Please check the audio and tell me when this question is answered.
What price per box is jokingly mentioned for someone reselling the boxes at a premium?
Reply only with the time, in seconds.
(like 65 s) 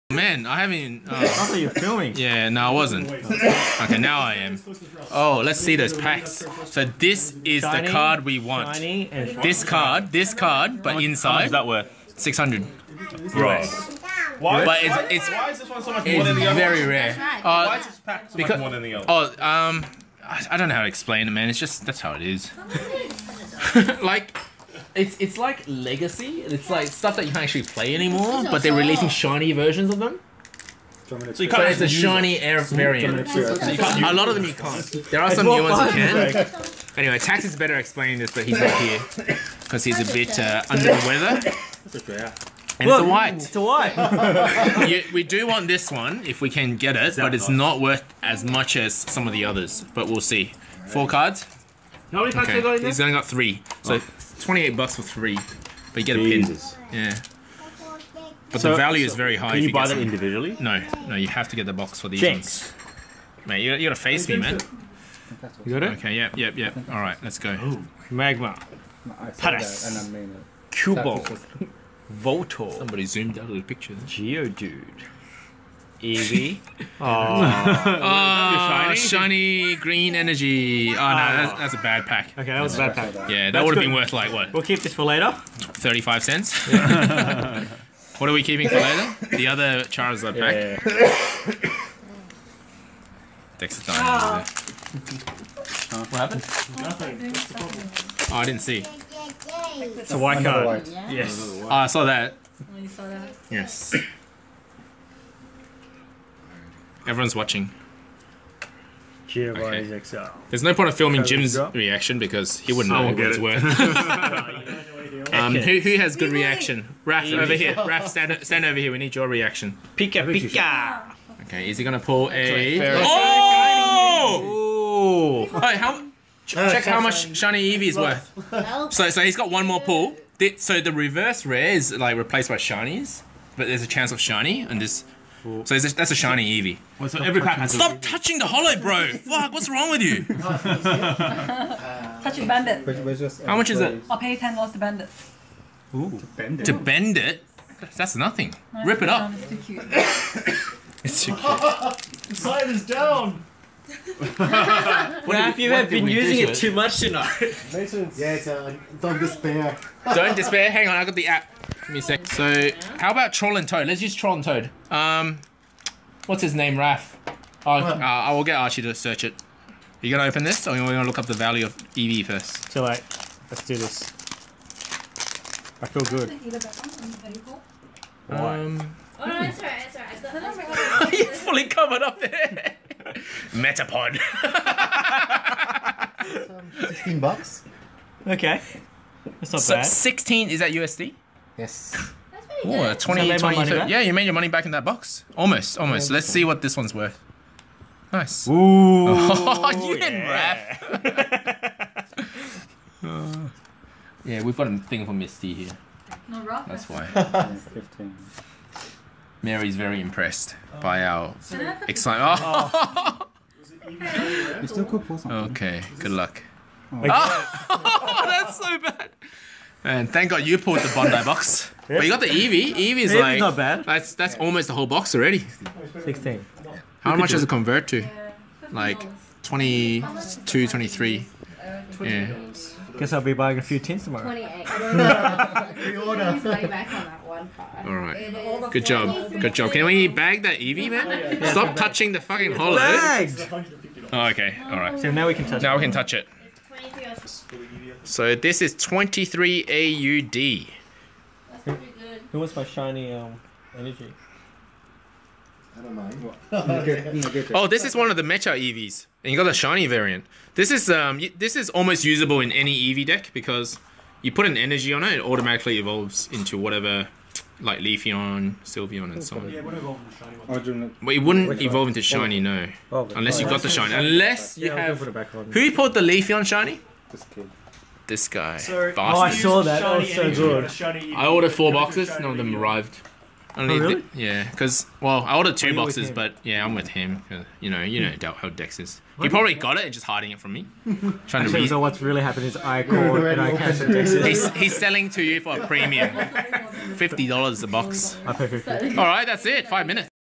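296 s.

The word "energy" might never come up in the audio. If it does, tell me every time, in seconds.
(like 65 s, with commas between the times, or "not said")
80 s, 253 s, 264 s.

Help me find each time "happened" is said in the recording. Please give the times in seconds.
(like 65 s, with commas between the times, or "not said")
96 s, 292 s.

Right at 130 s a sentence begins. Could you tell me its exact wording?
So the reverse is like replaced by Shinies, but there's a chance of Shiny, and this well, so that's a shiny Eevee.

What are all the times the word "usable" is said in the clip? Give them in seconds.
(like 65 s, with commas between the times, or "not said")
262 s.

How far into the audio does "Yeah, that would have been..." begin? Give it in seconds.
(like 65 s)
83 s.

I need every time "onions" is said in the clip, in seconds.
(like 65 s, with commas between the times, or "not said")
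not said.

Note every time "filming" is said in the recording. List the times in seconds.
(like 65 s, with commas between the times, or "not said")
1 s, 110 s.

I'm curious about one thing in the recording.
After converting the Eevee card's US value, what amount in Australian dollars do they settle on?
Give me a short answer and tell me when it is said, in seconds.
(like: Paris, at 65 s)
23, at 248 s.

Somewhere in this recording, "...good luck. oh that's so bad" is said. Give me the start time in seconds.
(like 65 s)
215 s.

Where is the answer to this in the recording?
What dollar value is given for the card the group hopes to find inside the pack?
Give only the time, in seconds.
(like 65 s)
12 s.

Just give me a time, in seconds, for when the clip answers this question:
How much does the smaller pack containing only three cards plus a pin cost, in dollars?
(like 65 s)
54 s.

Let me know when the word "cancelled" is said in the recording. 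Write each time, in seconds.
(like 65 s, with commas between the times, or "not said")
293 s.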